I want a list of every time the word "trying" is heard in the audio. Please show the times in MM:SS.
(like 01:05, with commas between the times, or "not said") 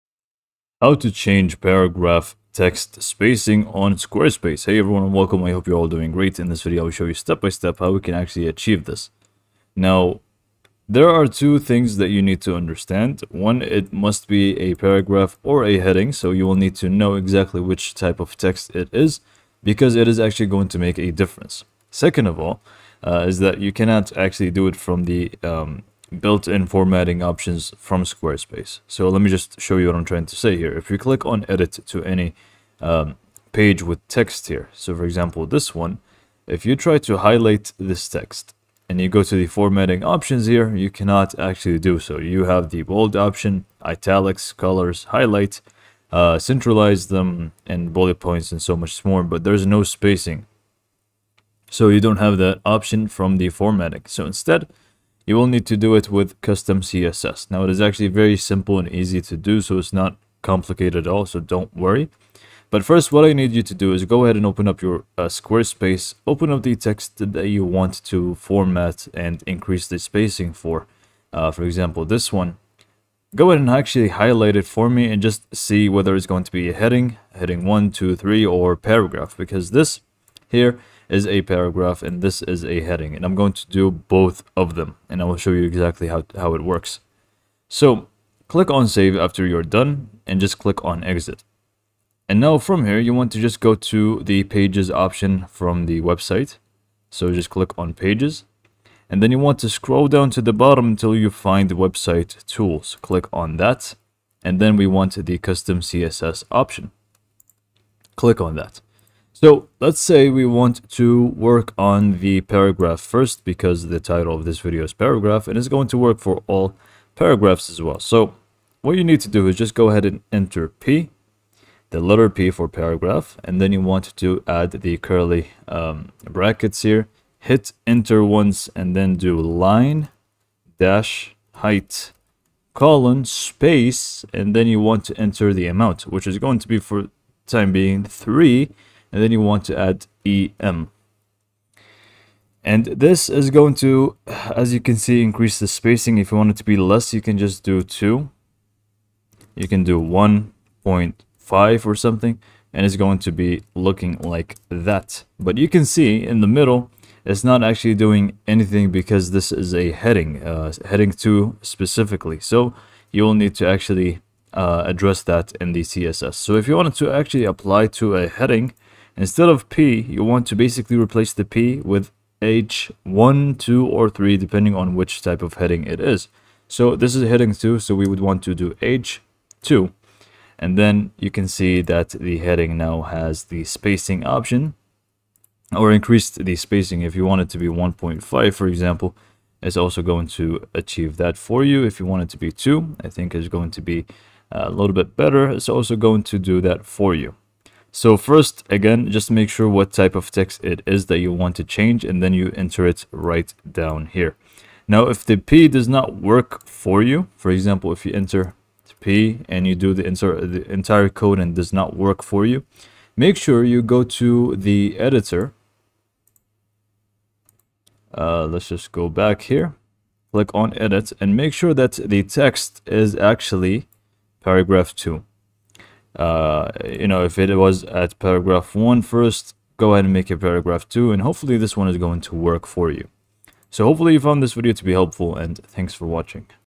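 00:30.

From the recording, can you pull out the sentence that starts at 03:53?
So hopefully you found this video to be helpful, and thanks for watching.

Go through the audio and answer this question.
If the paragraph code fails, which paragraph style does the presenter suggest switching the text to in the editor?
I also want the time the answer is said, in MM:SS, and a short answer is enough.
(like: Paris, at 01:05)
paragraph 2, at 03:50.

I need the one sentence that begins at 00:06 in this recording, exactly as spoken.
In this video I will show you step by step how we can actually achieve this.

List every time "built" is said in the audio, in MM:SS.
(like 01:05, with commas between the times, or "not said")
00:26.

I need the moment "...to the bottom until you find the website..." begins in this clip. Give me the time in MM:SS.
01:40.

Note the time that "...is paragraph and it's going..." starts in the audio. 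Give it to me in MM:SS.
01:54.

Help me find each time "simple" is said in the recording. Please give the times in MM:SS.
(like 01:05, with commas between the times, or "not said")
00:58.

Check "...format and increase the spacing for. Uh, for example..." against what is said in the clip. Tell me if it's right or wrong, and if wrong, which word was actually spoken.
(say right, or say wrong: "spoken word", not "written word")
right.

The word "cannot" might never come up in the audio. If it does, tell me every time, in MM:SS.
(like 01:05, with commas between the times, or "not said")
00:23, 00:40.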